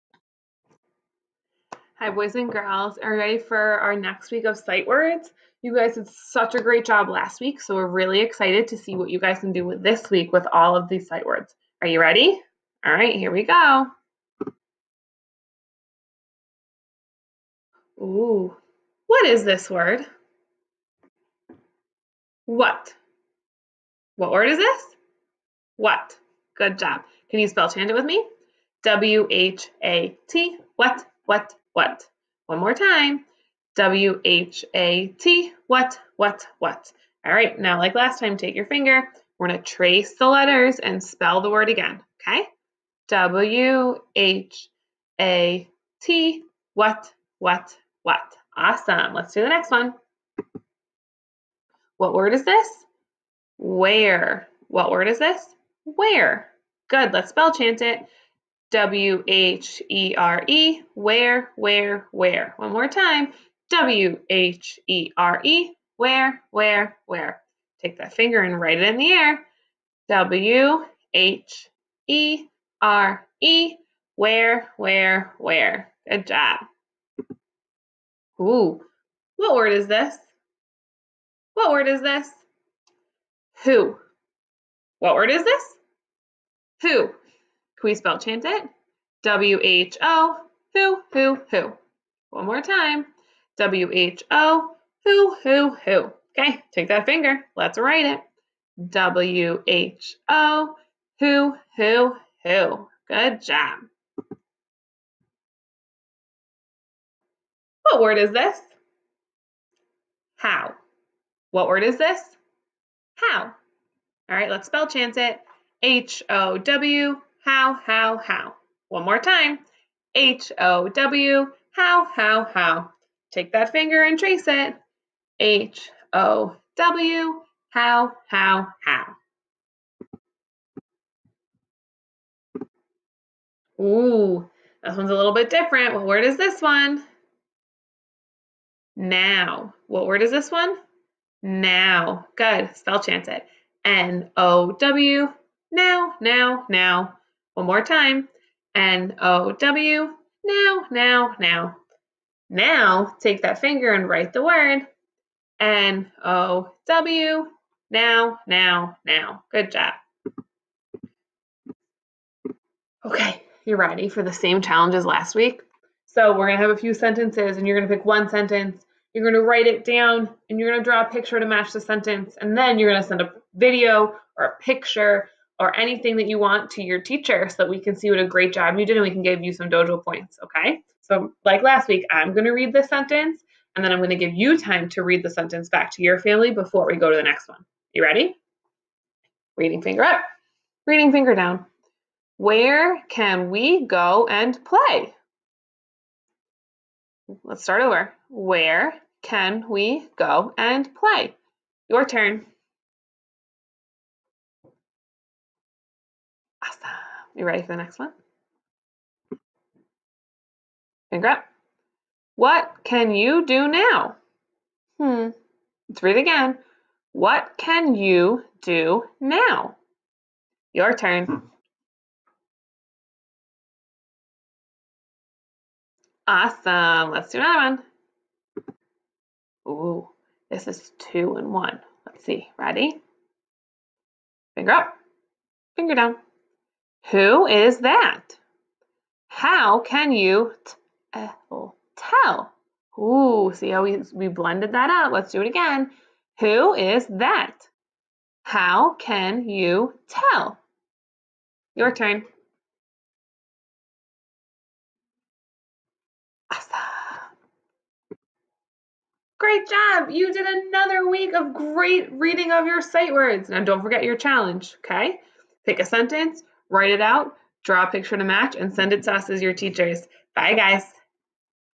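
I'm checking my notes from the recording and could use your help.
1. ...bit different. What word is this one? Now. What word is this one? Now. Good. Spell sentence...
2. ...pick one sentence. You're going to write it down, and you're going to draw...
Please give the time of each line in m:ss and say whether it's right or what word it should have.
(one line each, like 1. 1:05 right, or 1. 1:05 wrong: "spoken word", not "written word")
1. 2:15 wrong: "chance", not "sentence"
2. 2:47 right.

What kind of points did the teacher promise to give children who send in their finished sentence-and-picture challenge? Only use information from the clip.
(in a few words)
dojo points.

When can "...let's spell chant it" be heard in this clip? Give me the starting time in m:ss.
0:57.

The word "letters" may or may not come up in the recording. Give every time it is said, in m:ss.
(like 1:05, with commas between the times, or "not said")
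0:40.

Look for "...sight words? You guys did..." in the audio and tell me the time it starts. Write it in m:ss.
0:04.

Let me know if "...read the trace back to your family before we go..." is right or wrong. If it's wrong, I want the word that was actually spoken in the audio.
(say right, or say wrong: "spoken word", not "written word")
wrong: "sentence", not "trace".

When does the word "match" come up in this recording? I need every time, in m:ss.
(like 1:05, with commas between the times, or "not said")
2:51, 4:28.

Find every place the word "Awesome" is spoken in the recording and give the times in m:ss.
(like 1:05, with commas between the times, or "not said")
0:48, 3:46.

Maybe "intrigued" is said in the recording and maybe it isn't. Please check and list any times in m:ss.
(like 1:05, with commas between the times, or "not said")
not said.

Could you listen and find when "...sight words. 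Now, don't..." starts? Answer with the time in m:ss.
4:22.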